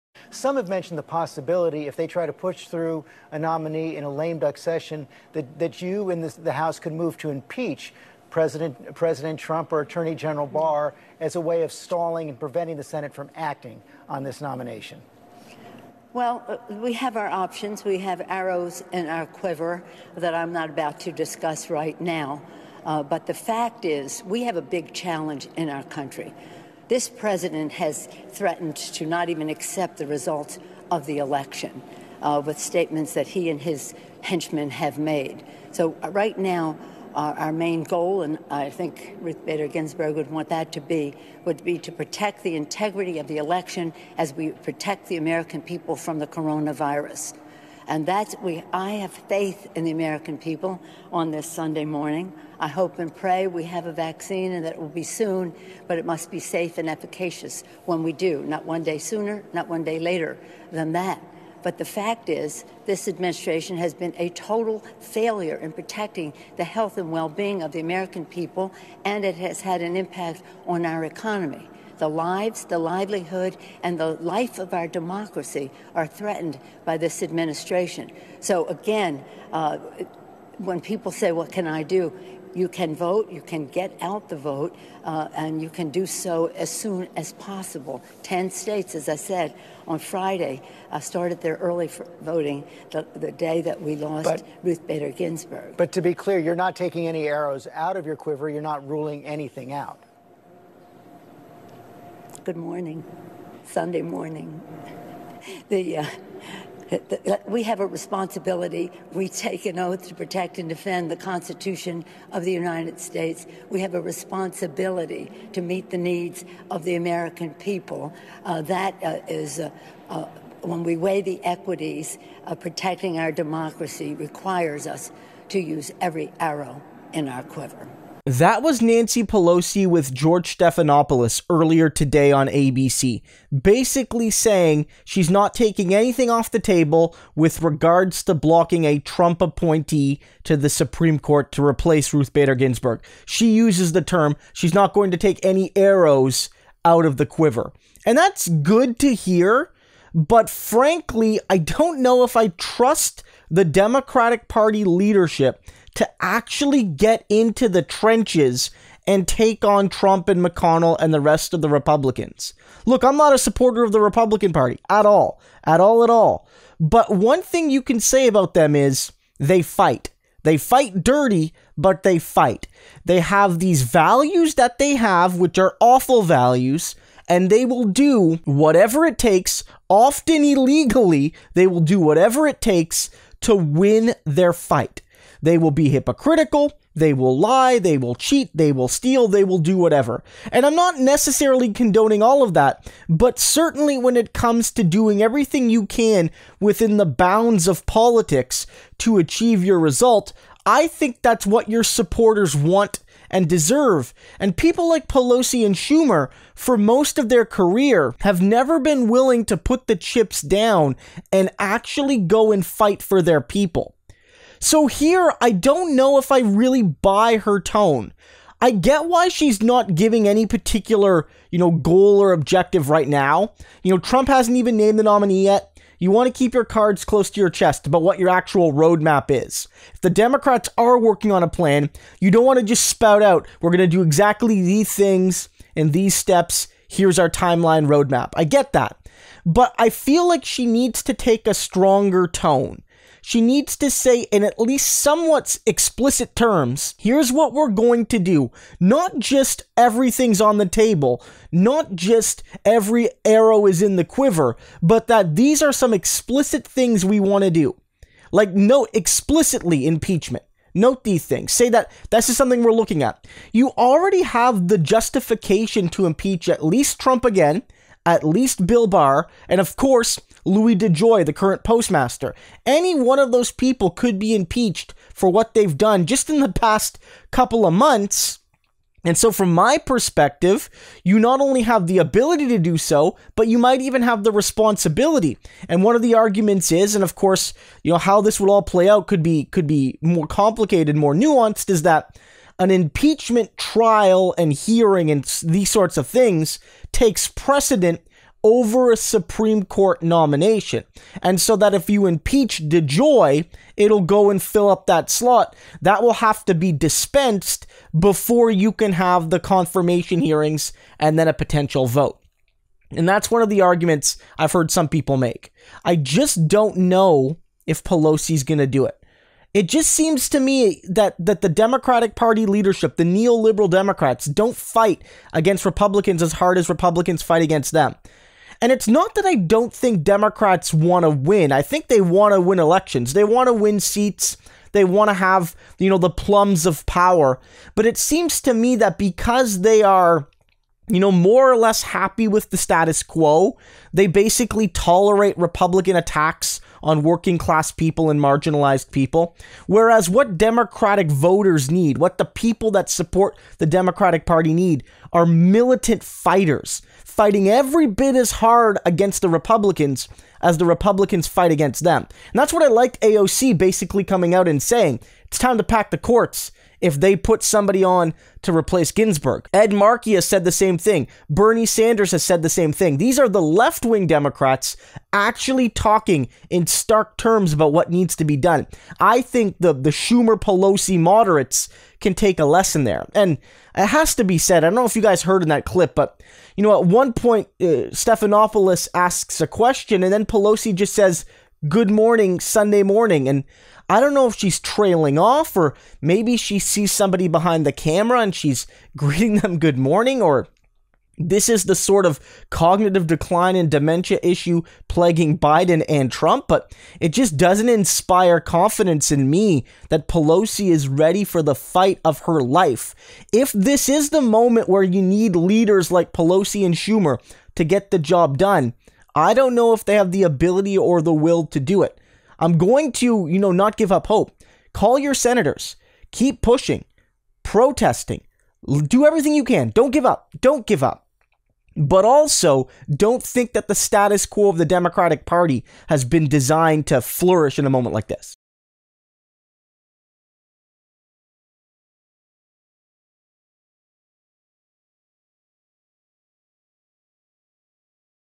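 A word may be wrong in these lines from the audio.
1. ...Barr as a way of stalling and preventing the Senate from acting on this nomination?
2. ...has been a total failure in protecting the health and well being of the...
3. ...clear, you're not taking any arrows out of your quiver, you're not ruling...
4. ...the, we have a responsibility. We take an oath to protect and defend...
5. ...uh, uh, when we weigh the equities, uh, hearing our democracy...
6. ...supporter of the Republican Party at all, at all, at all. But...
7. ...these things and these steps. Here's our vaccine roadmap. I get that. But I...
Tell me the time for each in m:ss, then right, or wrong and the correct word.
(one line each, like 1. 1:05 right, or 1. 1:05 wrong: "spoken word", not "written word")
1. 0:10 right
2. 1:03 right
3. 1:36 right
4. 1:46 right
5. 1:59 wrong: "protecting", not "hearing"
6. 2:43 right
7. 3:54 wrong: "timeline", not "vaccine".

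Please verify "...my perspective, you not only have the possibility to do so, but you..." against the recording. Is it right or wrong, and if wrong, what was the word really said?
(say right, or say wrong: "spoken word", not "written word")
wrong: "ability", not "possibility".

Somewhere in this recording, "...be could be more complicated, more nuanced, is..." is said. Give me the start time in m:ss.
4:49.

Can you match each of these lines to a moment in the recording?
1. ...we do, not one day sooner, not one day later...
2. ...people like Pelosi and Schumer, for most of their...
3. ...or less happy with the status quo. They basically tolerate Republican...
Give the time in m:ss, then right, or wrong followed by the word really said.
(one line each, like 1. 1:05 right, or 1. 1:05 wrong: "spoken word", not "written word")
1. 0:58 right
2. 3:24 right
3. 5:41 right.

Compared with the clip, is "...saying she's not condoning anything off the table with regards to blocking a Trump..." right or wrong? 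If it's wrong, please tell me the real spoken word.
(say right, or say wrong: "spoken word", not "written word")
wrong: "taking", not "condoning".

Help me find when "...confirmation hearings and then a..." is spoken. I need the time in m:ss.
5:09.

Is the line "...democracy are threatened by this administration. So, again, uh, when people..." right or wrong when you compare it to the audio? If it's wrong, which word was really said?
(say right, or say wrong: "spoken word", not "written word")
right.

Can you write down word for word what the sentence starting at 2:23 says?
She uses the term, she's not going to take any arrows out of the quiver.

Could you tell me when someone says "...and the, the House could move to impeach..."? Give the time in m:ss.
0:06.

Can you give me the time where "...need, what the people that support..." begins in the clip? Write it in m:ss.
5:51.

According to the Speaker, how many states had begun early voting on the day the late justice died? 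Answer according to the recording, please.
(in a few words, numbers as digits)
10.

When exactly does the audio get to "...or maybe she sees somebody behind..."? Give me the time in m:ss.
6:35.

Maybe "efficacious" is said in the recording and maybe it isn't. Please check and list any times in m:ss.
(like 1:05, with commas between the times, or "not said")
0:56.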